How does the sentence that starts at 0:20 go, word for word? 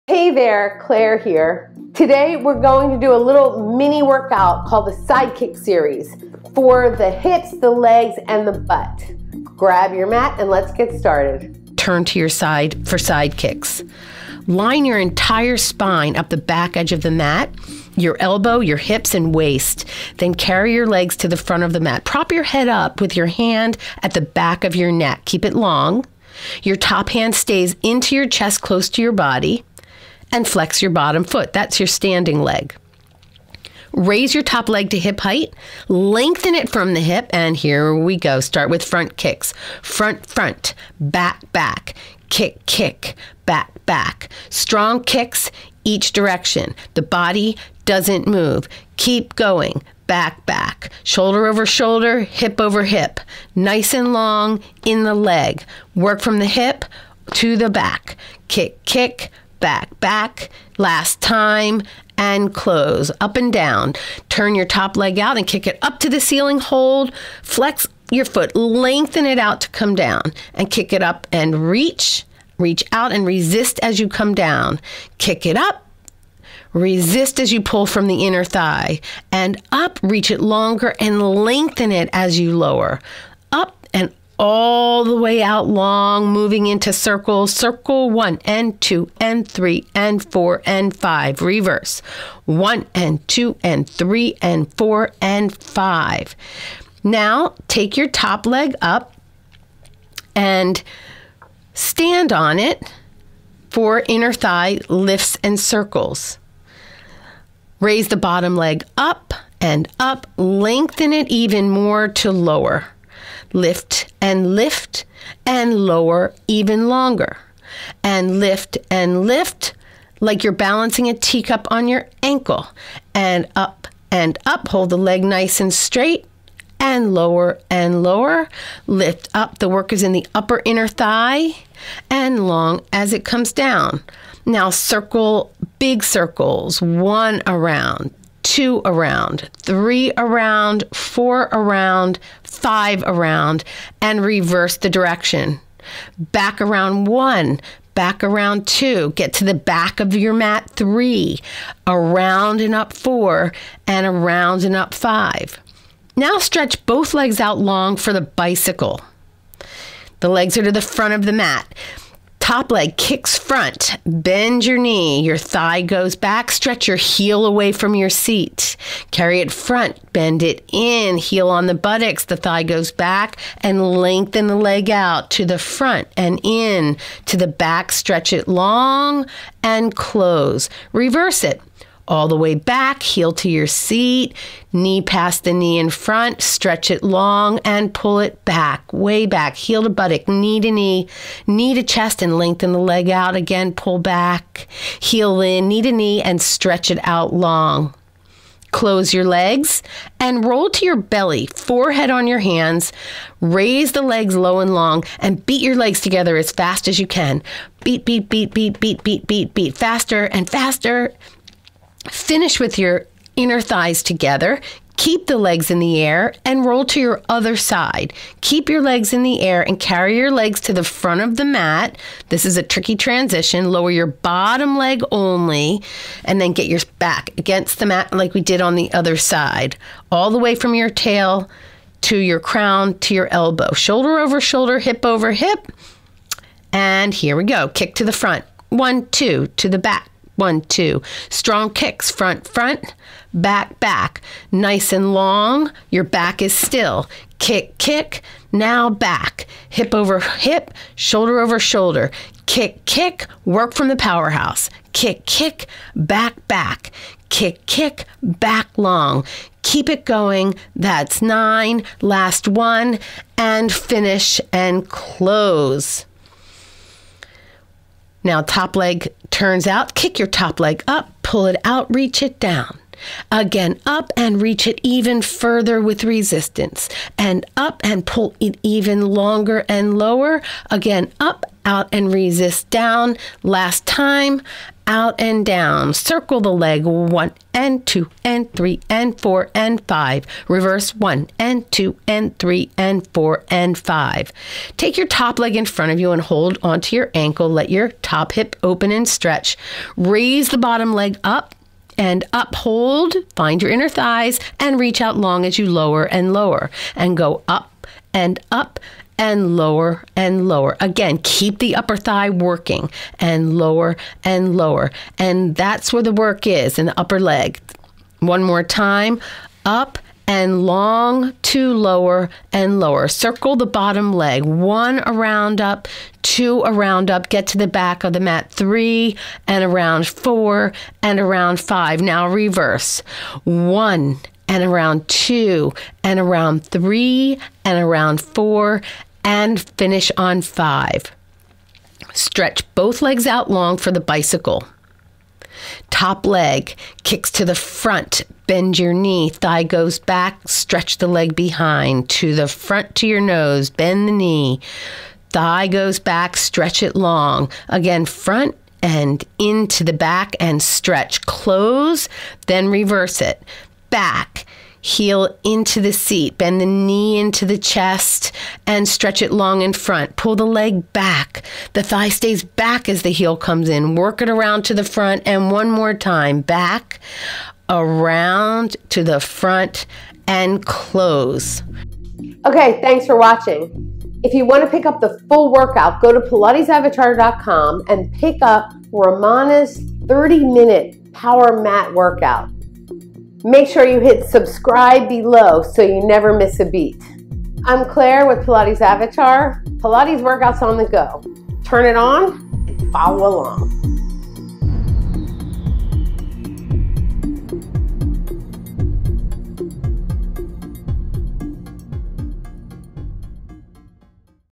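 Then carry your legs to the front of the mat.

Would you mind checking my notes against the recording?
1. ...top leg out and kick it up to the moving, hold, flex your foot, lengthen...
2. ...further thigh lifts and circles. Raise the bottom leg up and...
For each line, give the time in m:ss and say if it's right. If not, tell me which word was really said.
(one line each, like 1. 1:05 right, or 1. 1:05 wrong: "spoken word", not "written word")
1. 1:04 wrong: "ceiling", not "moving"
2. 1:44 wrong: "inner", not "further".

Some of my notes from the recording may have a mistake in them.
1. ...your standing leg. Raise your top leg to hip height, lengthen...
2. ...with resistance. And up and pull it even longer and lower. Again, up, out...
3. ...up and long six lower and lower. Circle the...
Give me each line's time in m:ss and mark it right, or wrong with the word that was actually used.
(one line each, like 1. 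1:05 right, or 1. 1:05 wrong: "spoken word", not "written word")
1. 0:31 right
2. 4:35 right
3. 5:19 wrong: "two", not "six".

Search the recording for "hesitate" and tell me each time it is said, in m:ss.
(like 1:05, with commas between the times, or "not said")
not said.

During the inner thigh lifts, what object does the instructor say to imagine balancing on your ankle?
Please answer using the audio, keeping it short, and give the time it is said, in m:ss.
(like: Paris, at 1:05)
a teacup, at 2:01.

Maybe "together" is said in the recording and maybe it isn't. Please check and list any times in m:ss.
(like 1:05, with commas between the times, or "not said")
3:26, 3:34.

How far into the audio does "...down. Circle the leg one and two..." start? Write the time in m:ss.
4:45.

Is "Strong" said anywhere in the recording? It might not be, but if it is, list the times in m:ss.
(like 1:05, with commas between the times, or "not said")
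0:44, 4:01.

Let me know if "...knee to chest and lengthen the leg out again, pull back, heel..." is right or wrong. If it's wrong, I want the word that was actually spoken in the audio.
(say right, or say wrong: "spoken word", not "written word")
right.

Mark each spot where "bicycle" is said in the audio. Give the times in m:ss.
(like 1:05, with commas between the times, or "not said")
2:38, 5:43.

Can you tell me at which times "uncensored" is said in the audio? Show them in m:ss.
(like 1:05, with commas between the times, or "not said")
not said.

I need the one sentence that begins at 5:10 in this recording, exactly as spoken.
Again, keep the upper thigh working and lower and lower.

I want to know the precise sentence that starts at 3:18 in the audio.
Close your legs and roll to your belly, forehead on your hands.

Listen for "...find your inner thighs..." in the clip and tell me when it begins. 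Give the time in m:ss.
5:03.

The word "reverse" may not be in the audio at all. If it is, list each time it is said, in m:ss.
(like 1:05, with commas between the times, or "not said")
1:31, 2:24, 3:00, 4:50, 5:32, 6:02.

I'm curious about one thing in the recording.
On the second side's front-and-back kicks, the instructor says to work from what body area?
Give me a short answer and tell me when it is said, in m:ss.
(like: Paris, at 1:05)
the powerhouse, at 4:13.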